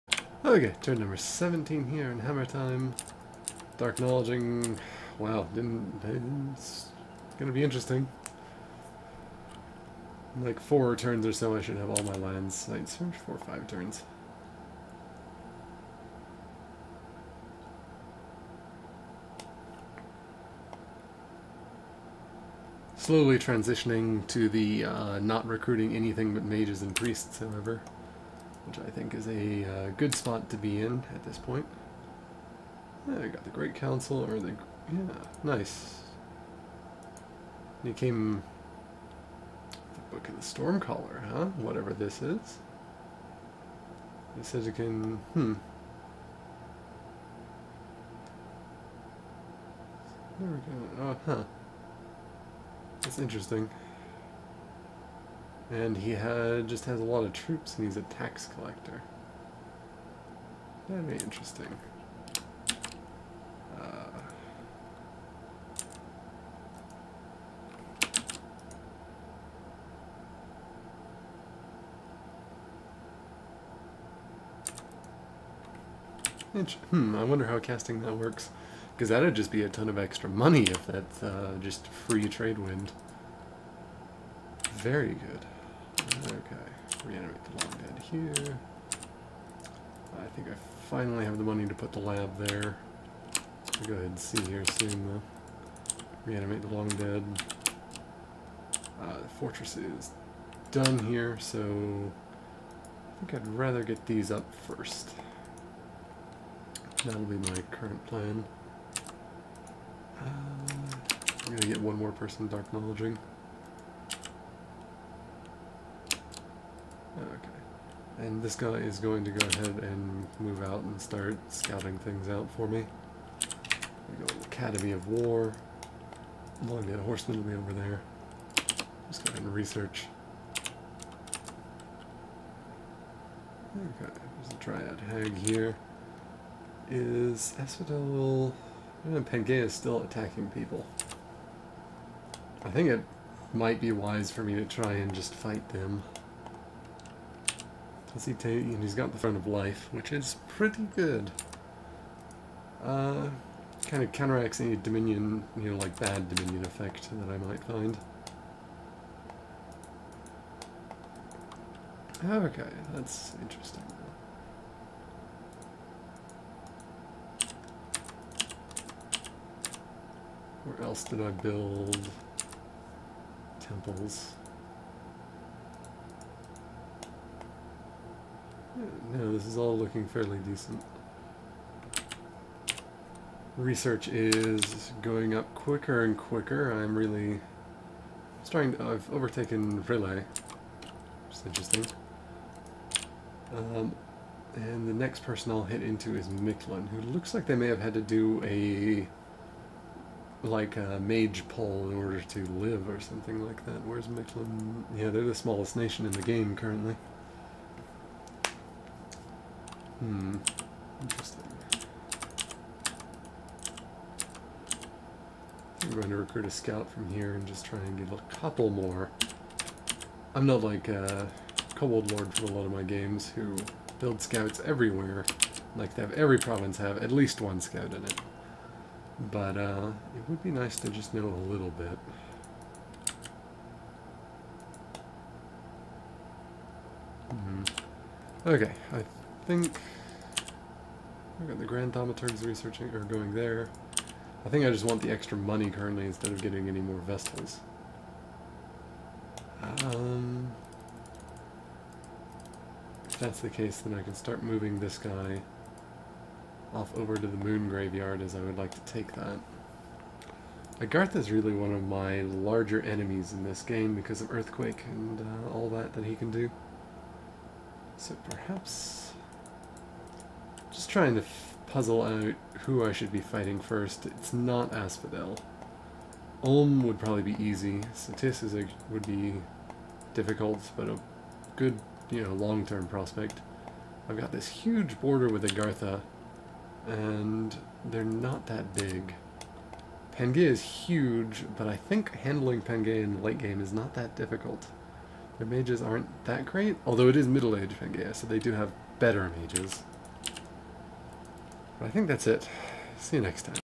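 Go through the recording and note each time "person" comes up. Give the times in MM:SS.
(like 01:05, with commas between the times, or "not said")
01:52, 03:15.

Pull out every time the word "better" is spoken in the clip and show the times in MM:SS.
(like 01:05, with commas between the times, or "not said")
04:58.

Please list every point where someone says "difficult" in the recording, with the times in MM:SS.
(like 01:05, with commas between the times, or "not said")
04:40, 04:54.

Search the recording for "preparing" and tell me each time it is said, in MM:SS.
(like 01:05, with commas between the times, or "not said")
not said.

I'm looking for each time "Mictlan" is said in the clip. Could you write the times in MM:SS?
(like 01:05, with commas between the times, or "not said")
03:16, 03:24.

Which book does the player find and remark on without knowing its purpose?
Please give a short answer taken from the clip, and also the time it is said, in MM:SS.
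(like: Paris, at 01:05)
The Book of the Stormcaller, at 00:39.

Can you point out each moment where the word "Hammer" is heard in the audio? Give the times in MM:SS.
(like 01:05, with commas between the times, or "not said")
00:02.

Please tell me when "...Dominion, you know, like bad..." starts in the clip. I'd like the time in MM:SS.
02:34.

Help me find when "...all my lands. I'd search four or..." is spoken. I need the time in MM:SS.
00:11.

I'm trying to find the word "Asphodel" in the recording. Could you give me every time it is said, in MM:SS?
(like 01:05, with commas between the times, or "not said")
02:17, 04:34.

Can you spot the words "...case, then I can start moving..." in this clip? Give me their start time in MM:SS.
04:13.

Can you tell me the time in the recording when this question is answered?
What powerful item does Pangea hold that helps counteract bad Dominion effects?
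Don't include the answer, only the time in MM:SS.
02:29.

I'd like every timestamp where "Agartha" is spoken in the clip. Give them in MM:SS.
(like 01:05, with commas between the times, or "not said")
04:20, 04:45.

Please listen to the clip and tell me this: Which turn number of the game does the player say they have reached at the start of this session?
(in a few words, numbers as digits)
17.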